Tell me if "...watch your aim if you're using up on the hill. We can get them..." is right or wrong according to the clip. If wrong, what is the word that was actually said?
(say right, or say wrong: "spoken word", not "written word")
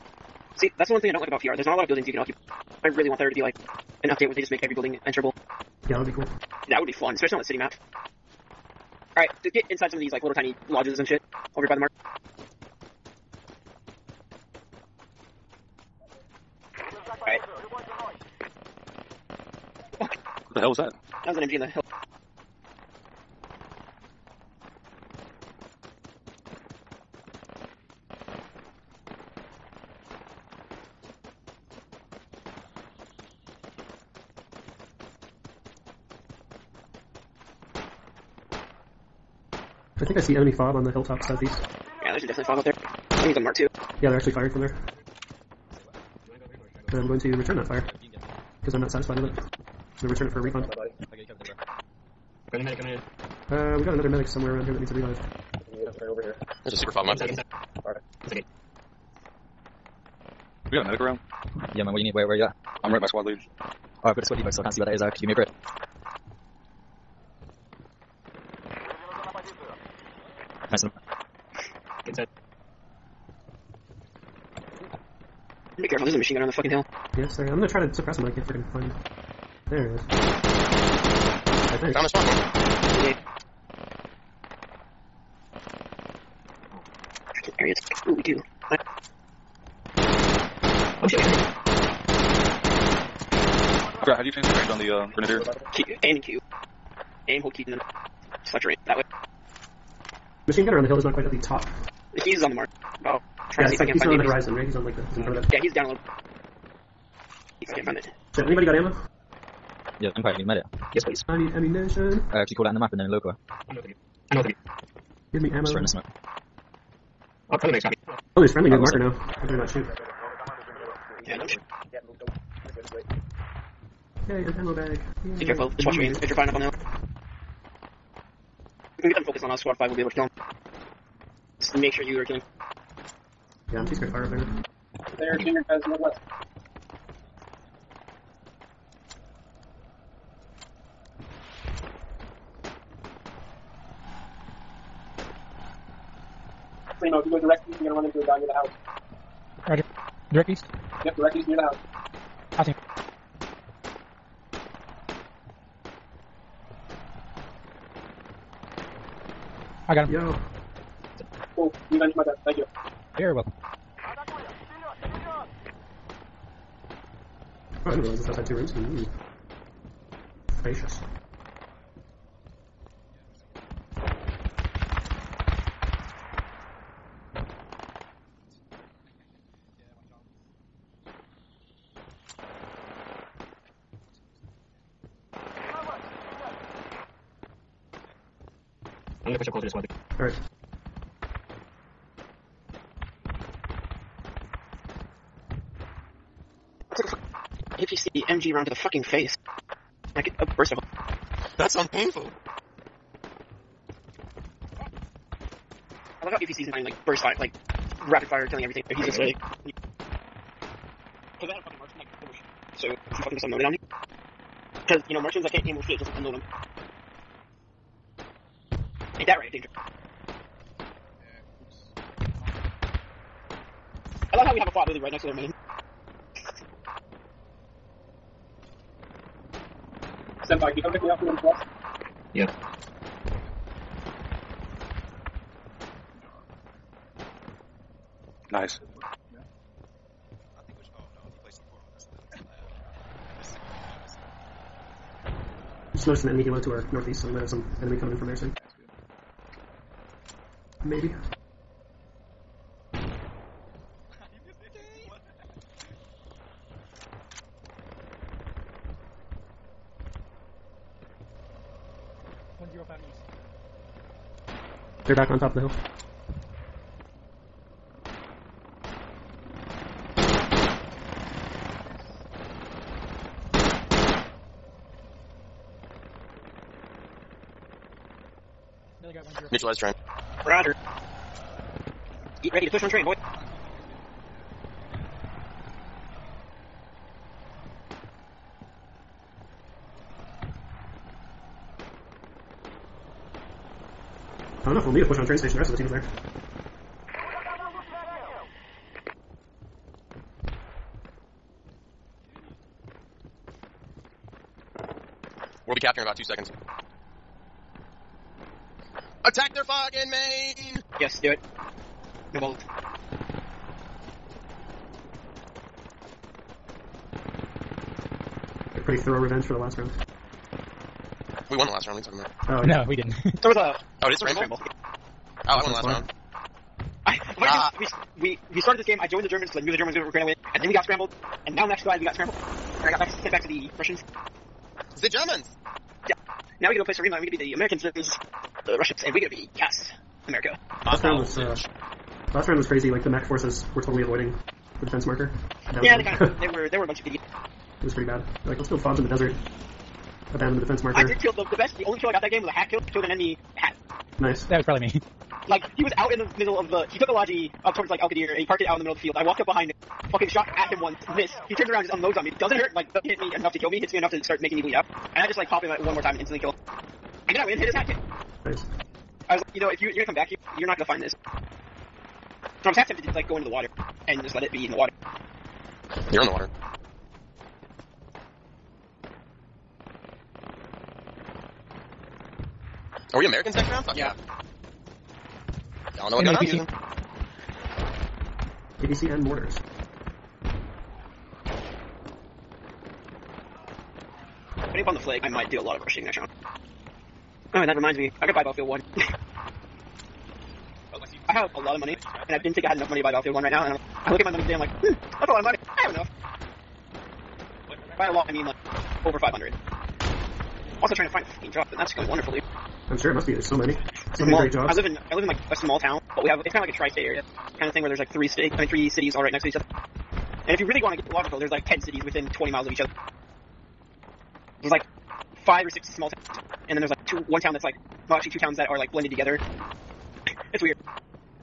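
wrong: "firing", not "using".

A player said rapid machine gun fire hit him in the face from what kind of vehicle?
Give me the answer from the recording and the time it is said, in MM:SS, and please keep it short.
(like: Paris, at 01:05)
APC, at 03:17.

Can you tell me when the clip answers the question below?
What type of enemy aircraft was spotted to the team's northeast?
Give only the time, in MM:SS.
04:06.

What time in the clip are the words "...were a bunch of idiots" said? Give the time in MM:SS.
05:46.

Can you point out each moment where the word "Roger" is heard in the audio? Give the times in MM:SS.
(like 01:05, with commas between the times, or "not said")
02:29, 04:40.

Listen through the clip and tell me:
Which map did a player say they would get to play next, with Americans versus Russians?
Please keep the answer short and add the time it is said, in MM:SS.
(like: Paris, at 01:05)
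Saaremaa, at 05:36.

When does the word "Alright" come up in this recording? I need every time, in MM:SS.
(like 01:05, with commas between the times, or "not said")
00:09, 03:10, 06:37.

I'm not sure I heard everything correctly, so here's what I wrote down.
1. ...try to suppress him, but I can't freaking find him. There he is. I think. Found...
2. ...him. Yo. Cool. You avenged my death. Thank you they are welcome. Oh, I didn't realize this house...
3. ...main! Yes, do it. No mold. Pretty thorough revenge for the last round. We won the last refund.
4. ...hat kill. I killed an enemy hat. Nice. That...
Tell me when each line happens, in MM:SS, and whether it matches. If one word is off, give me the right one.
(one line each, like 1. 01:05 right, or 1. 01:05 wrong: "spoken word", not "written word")
1. 01:17 right
2. 02:40 right
3. 05:10 wrong: "round", not "refund"
4. 05:52 right.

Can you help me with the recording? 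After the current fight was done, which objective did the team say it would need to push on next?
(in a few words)
Train station.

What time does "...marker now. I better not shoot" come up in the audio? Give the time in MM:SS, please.
01:58.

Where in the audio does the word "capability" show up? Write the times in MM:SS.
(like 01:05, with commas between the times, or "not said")
not said.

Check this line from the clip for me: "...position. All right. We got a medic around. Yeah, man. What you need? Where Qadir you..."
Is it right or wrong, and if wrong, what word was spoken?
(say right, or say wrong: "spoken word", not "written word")
wrong: "Where", not "Qadir".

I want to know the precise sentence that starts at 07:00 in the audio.
And if you really want to get logical, there's like 10 cities within 20 miles of each other.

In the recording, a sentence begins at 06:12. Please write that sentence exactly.
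I was half tempted to like go into the water and just let it be in the water.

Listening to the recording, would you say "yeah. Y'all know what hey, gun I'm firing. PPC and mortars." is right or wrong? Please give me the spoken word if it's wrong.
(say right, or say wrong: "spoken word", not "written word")
wrong: "using", not "firing".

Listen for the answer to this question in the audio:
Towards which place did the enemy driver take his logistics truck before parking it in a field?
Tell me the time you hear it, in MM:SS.
05:57.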